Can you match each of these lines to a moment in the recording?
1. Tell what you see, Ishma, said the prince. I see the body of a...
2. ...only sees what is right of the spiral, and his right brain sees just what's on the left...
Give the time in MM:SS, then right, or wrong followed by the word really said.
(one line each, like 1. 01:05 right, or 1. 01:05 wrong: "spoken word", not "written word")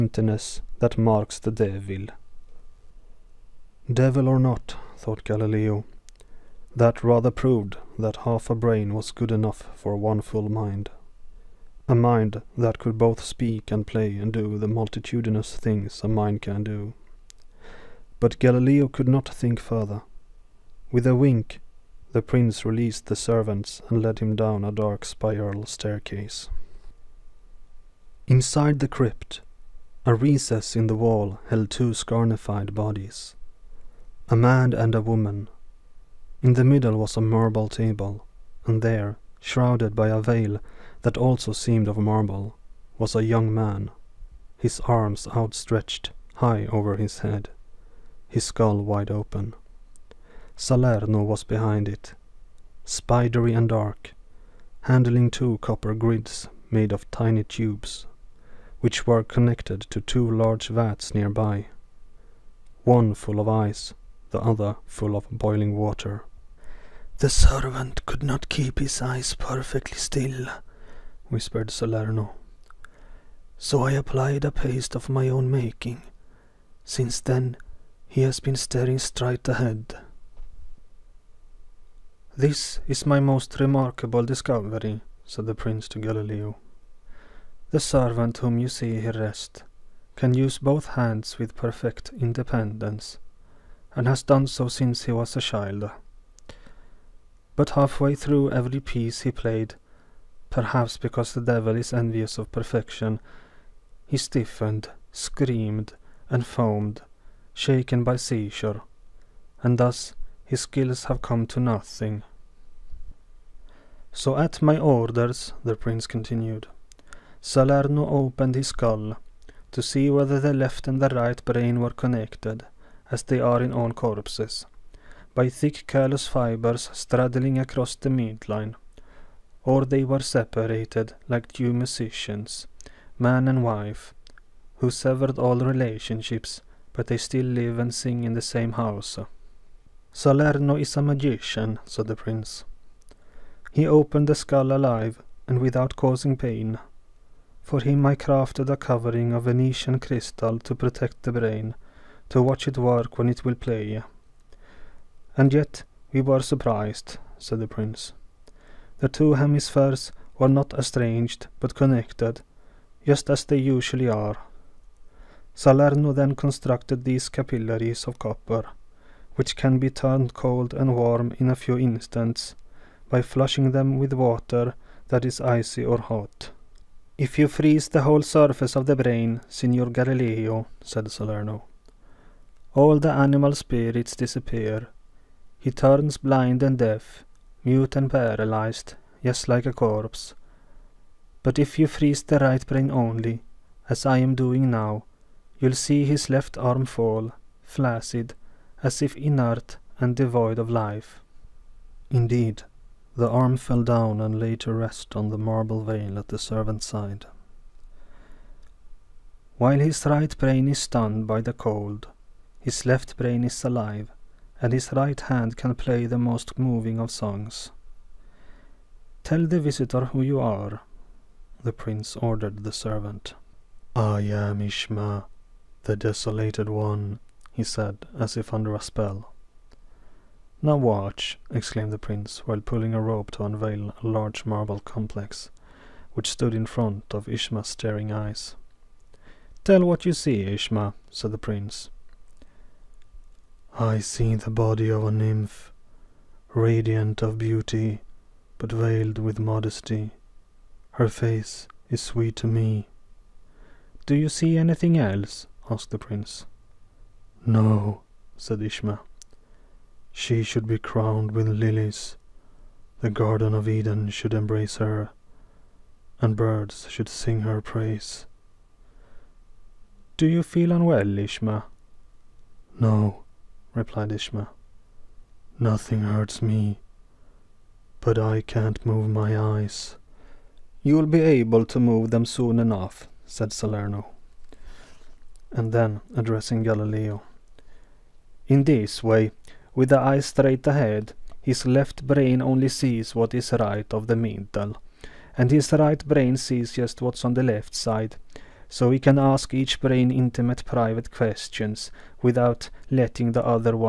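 1. 03:59 right
2. 04:52 wrong: "mental", not "spiral".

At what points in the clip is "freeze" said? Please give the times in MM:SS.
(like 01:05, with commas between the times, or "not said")
02:57, 03:11.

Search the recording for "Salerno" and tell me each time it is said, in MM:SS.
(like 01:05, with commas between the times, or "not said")
00:50, 01:11, 01:57, 02:20, 02:45, 03:01, 04:43.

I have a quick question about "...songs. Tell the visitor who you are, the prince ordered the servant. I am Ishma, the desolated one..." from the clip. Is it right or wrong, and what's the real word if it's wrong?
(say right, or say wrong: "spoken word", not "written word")
right.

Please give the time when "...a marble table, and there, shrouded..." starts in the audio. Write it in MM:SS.
00:37.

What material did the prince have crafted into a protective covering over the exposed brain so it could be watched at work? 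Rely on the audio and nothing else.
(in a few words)
Venetian crystal.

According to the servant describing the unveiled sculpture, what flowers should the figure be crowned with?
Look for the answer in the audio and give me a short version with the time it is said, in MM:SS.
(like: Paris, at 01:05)
lilies, at 04:21.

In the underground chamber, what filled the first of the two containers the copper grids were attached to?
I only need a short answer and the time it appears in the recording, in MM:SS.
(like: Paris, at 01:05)
ice, at 01:02.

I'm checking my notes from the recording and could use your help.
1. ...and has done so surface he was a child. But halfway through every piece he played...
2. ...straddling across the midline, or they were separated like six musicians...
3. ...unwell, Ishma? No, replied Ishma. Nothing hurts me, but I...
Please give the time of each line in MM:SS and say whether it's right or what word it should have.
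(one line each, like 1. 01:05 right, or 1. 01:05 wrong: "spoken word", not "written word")
1. 01:33 wrong: "since", not "surface"
2. 02:06 wrong: "two", not "six"
3. 04:30 right.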